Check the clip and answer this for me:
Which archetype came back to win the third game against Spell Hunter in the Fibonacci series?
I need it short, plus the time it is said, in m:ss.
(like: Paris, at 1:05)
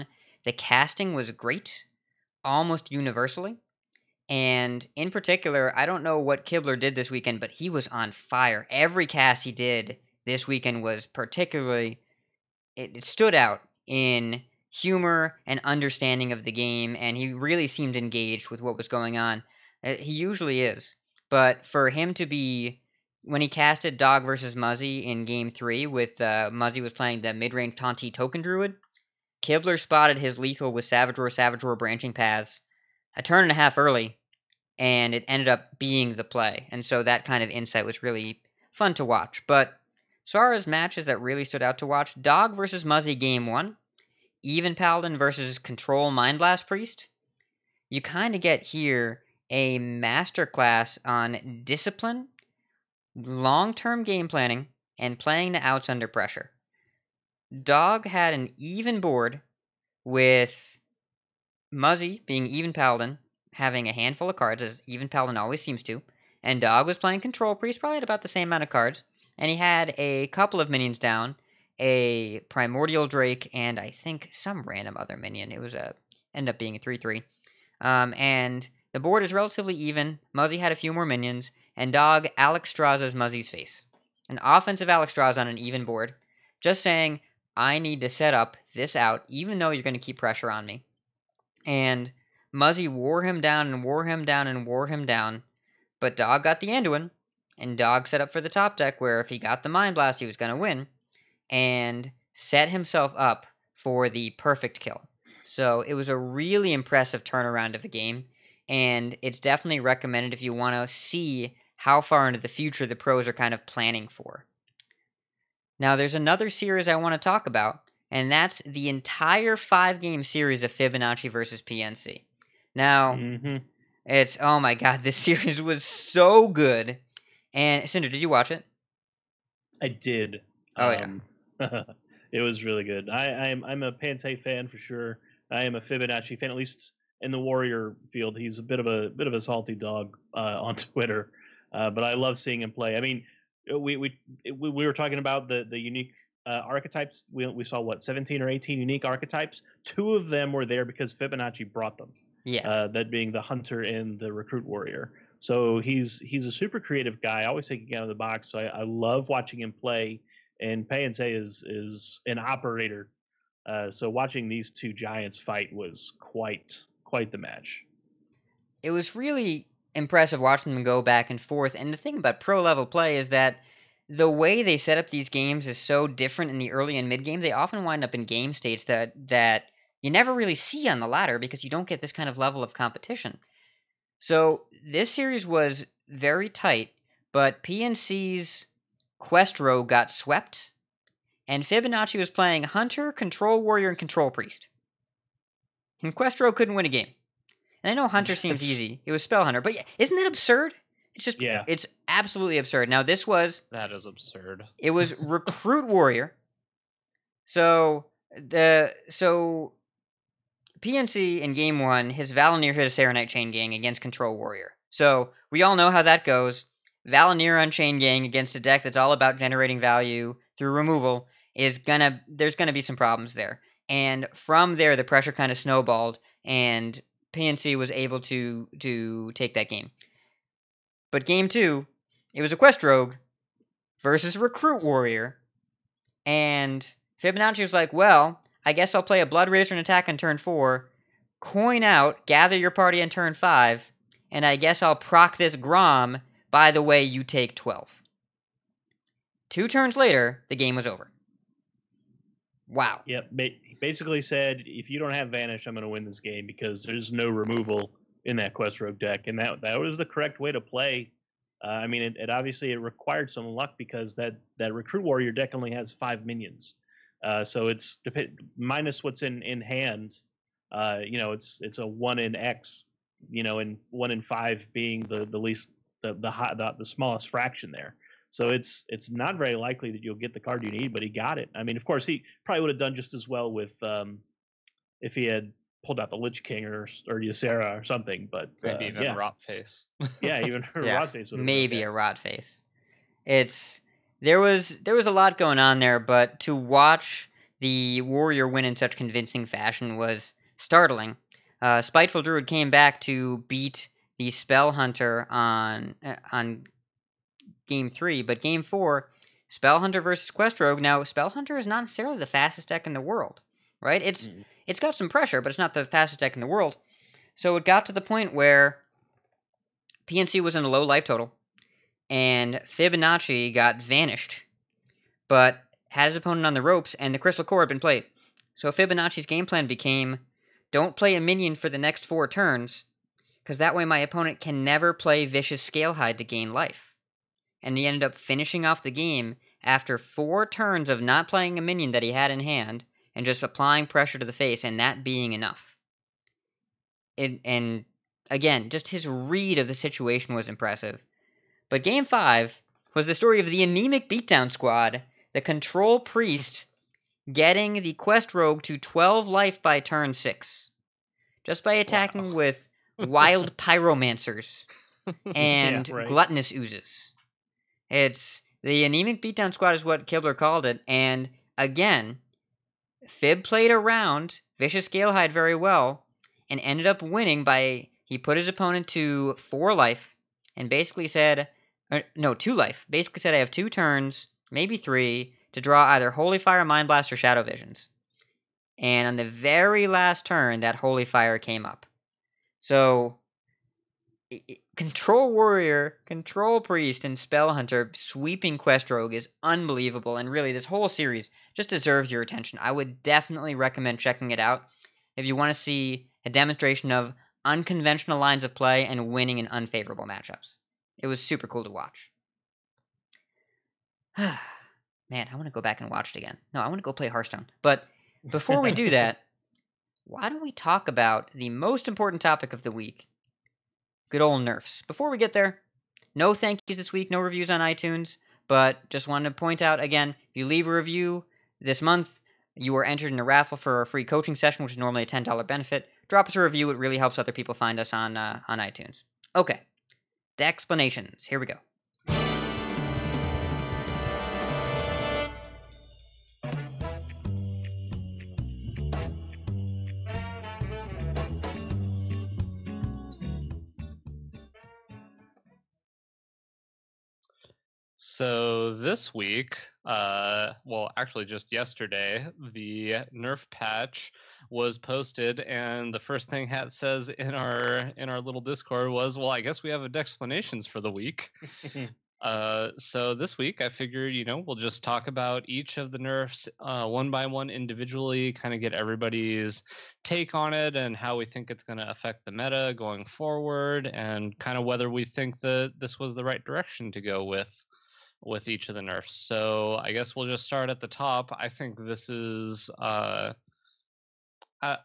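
Spiteful Druid, at 5:01.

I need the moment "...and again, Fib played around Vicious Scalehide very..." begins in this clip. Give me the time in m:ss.
6:10.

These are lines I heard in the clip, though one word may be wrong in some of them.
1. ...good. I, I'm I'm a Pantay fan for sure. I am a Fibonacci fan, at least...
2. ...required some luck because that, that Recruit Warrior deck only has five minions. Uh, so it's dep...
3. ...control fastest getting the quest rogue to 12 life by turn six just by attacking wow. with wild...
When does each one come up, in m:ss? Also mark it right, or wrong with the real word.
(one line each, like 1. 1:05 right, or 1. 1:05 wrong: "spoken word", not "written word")
1. 2:12 right
2. 4:22 right
3. 5:55 wrong: "priest", not "fastest".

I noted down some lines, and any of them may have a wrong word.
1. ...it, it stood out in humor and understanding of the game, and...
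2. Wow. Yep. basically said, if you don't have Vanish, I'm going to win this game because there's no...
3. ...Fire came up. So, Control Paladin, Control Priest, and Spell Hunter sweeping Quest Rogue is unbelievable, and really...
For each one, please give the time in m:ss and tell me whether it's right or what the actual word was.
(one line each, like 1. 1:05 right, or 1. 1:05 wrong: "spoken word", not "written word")
1. 0:12 right
2. 4:12 right
3. 6:31 wrong: "Warrior", not "Paladin".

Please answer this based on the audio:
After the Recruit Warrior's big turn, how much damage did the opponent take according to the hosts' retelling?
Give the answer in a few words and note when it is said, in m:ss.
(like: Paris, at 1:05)
12, at 4:07.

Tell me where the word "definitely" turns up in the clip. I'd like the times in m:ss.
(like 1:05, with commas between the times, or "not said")
1:49, 6:43.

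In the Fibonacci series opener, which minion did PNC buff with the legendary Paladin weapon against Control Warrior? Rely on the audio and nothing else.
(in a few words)
Saronite Chain Gang.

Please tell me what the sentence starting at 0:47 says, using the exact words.
You kind of get here a masterclass on discipline, long term game planning, and playing the outs under pressure.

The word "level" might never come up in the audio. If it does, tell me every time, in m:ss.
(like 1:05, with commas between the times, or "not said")
2:52, 3:02.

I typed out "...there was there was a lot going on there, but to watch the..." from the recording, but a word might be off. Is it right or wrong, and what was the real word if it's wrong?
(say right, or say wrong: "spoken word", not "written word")
right.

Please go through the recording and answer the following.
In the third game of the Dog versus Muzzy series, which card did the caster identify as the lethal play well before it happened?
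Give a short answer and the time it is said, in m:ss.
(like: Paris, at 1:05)
Savage Roar, at 0:31.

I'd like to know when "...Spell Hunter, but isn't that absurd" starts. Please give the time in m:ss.
3:19.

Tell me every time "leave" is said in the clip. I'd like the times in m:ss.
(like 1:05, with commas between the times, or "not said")
7:10.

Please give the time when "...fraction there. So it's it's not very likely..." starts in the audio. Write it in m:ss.
4:37.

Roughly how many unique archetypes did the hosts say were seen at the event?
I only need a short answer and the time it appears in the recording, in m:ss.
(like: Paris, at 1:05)
17 or 18, at 2:28.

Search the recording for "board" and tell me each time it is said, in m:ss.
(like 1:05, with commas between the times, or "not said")
0:59, 1:19, 1:25.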